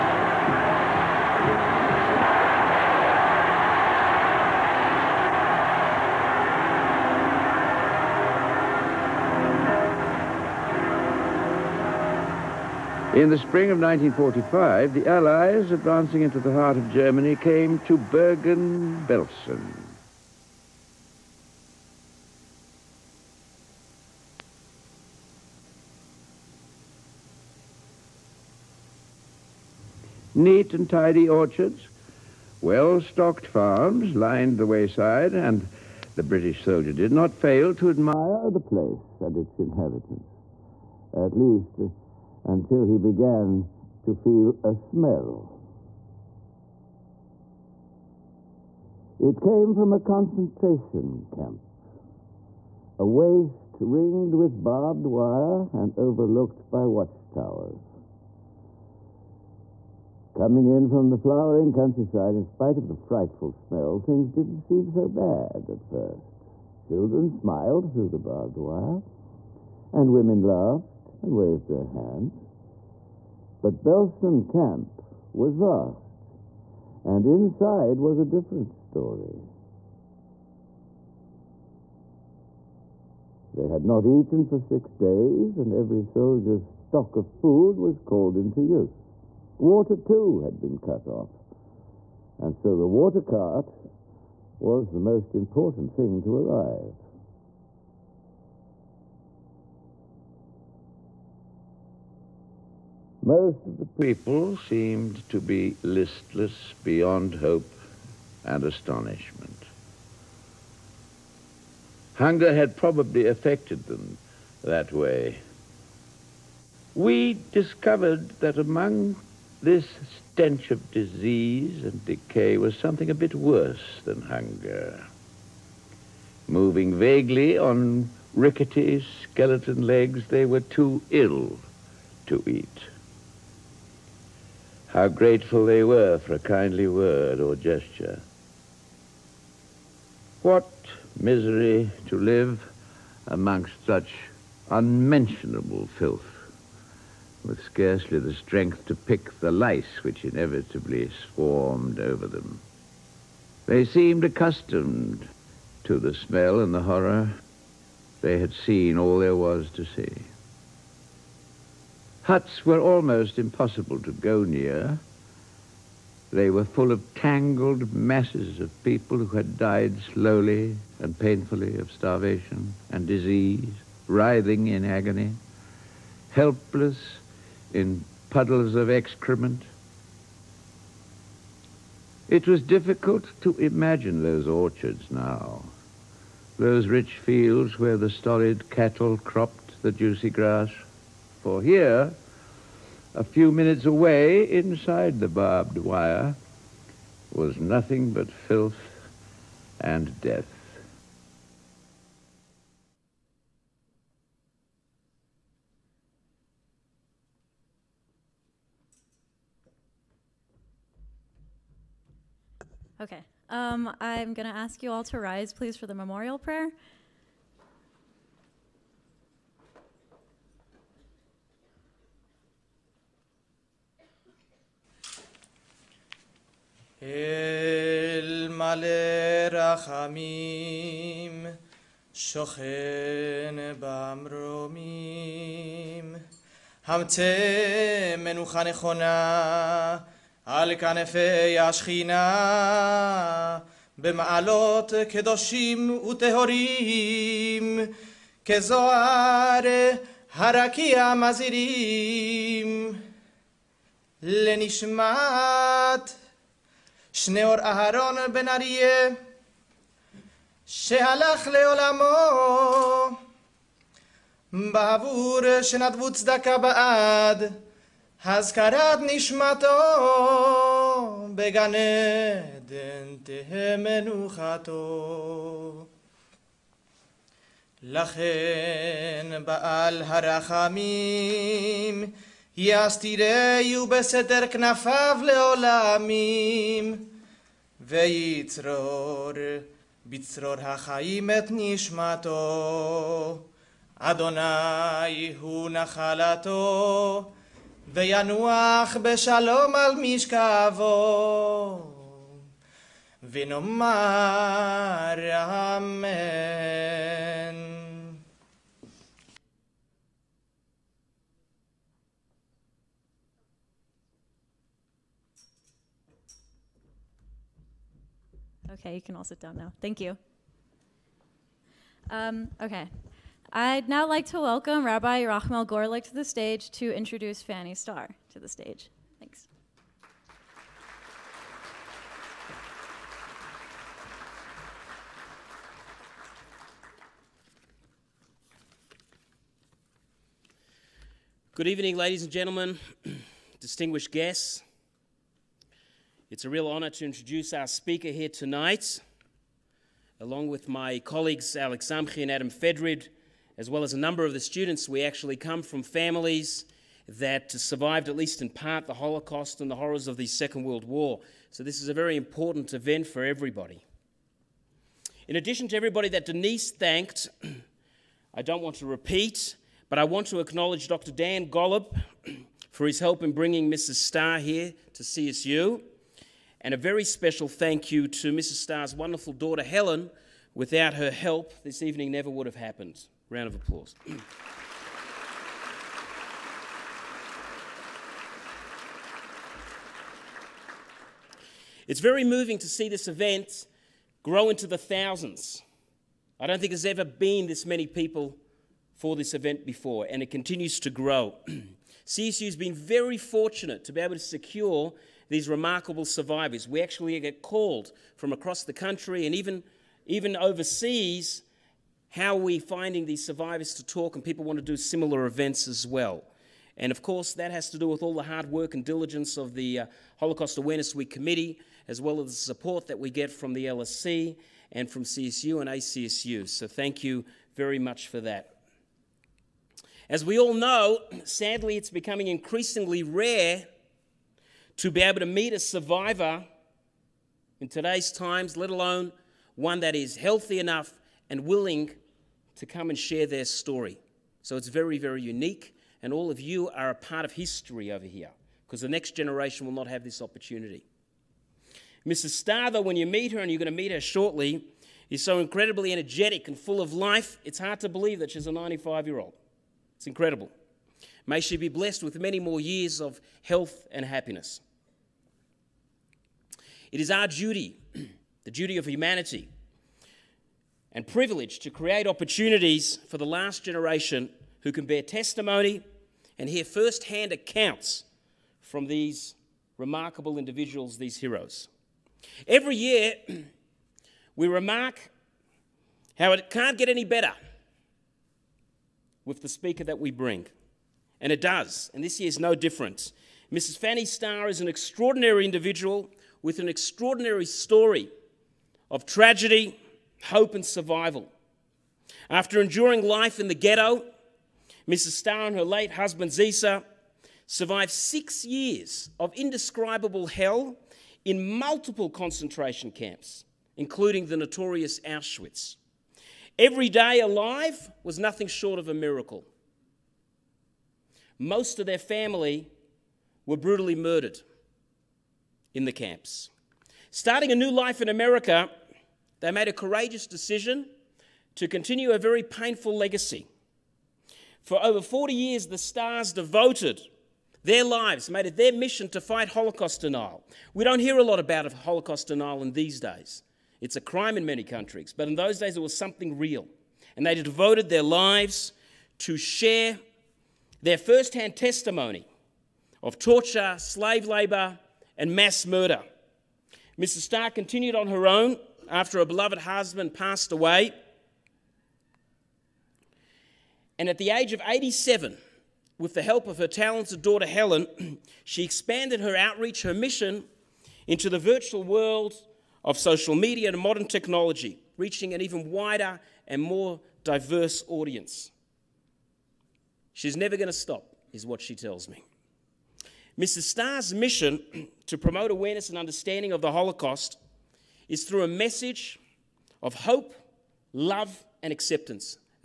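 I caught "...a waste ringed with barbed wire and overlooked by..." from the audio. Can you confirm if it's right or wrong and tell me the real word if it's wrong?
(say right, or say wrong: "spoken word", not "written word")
right.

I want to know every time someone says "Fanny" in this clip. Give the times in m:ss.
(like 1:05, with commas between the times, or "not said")
5:27, 8:13.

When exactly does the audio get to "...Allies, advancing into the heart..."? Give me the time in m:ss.
0:15.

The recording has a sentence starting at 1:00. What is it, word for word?
Coming in from the flowering countryside, in spite of the frightful smell, things didn't seem so bad at first.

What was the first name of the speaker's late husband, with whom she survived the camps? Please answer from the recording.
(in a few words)
Zisa.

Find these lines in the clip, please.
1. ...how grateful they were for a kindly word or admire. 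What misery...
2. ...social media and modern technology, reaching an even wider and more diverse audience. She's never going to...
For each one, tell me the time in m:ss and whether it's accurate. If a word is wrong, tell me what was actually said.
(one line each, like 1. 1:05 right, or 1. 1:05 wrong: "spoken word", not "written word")
1. 2:14 wrong: "gesture", not "admire"
2. 9:32 right.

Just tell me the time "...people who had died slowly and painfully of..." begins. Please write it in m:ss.
2:48.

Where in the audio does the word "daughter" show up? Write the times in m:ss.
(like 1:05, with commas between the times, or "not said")
6:19, 9:27.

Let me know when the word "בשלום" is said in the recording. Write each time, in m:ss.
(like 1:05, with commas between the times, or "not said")
4:59.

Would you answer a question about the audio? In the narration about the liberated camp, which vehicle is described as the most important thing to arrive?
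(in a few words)
The water cart.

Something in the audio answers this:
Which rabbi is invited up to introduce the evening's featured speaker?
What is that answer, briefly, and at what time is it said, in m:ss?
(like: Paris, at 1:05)
Rachmel Gorlick, at 5:25.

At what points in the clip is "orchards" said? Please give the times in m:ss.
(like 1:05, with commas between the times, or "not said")
0:31, 3:04.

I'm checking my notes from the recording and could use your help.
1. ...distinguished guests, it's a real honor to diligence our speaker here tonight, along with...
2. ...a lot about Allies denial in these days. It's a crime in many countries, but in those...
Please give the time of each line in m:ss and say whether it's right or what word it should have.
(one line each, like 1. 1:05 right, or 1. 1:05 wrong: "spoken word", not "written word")
1. 5:43 wrong: "introduce", not "diligence"
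2. 9:01 wrong: "Holocaust", not "Allies".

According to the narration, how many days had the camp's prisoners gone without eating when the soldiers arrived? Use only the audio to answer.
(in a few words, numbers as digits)
6.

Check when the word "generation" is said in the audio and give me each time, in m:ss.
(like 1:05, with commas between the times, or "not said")
7:29, 7:53.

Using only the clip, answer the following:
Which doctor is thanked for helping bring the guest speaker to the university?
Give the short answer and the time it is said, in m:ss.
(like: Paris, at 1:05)
Dan Golub, at 6:10.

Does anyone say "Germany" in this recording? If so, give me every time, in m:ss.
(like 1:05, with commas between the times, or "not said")
0:16.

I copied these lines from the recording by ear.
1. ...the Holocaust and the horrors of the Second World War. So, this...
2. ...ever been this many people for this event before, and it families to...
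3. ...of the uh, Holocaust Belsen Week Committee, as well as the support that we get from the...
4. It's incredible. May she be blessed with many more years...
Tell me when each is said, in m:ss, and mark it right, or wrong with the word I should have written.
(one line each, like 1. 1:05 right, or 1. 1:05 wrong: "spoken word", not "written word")
1. 5:58 right
2. 6:36 wrong: "continues", not "families"
3. 6:59 wrong: "Awareness", not "Belsen"
4. 7:39 right.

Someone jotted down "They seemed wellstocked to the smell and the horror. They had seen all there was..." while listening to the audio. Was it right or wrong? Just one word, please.
wrong.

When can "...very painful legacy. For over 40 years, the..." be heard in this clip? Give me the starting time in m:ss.
8:52.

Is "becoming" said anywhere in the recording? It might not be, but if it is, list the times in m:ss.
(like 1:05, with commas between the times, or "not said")
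7:11.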